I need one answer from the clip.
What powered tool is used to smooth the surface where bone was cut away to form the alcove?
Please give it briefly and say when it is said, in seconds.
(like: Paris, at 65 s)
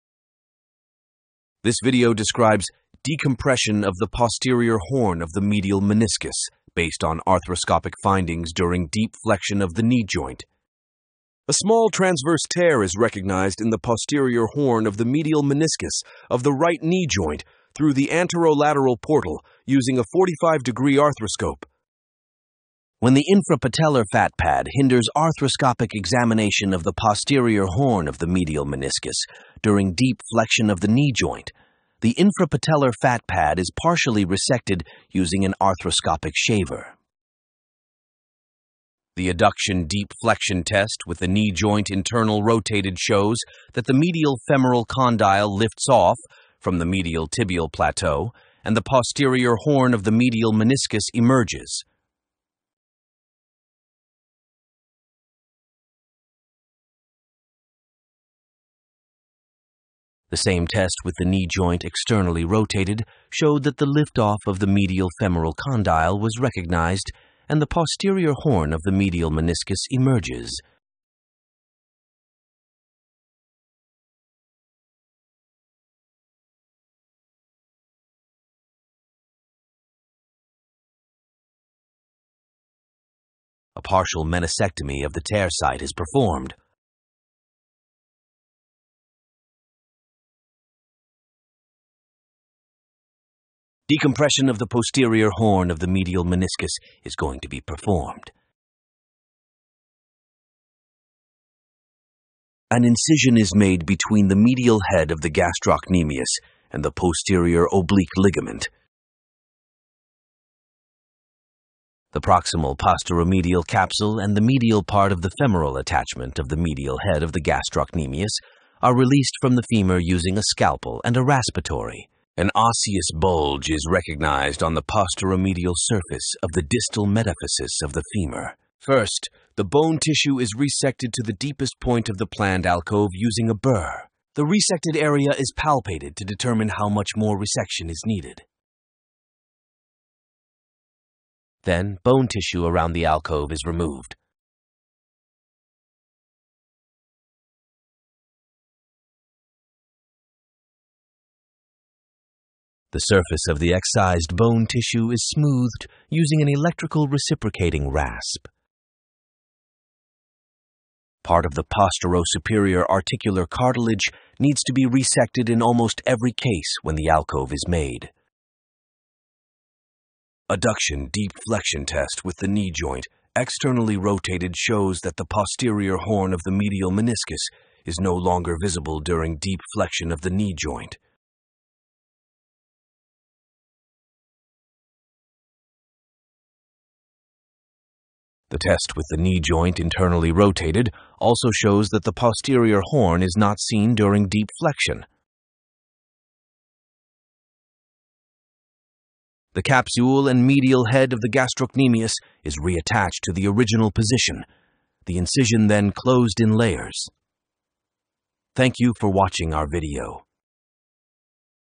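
electrical reciprocating rasp, at 156 s.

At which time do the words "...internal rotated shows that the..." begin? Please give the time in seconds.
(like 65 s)
41 s.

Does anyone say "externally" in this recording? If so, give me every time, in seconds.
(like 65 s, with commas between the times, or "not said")
61 s, 173 s.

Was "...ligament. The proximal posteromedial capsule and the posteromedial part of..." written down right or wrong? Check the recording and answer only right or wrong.
wrong.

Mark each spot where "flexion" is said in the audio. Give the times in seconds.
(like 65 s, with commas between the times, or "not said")
9 s, 30 s, 40 s, 171 s, 179 s, 194 s.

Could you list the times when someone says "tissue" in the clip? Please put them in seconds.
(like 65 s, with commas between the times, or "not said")
129 s, 142 s, 154 s.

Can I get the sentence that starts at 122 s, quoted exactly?
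An osseous bulge is recognized on the posteromedial surface of the distal metaphysis of the femur.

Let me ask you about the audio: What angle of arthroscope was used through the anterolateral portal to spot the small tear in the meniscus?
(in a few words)
45 degree.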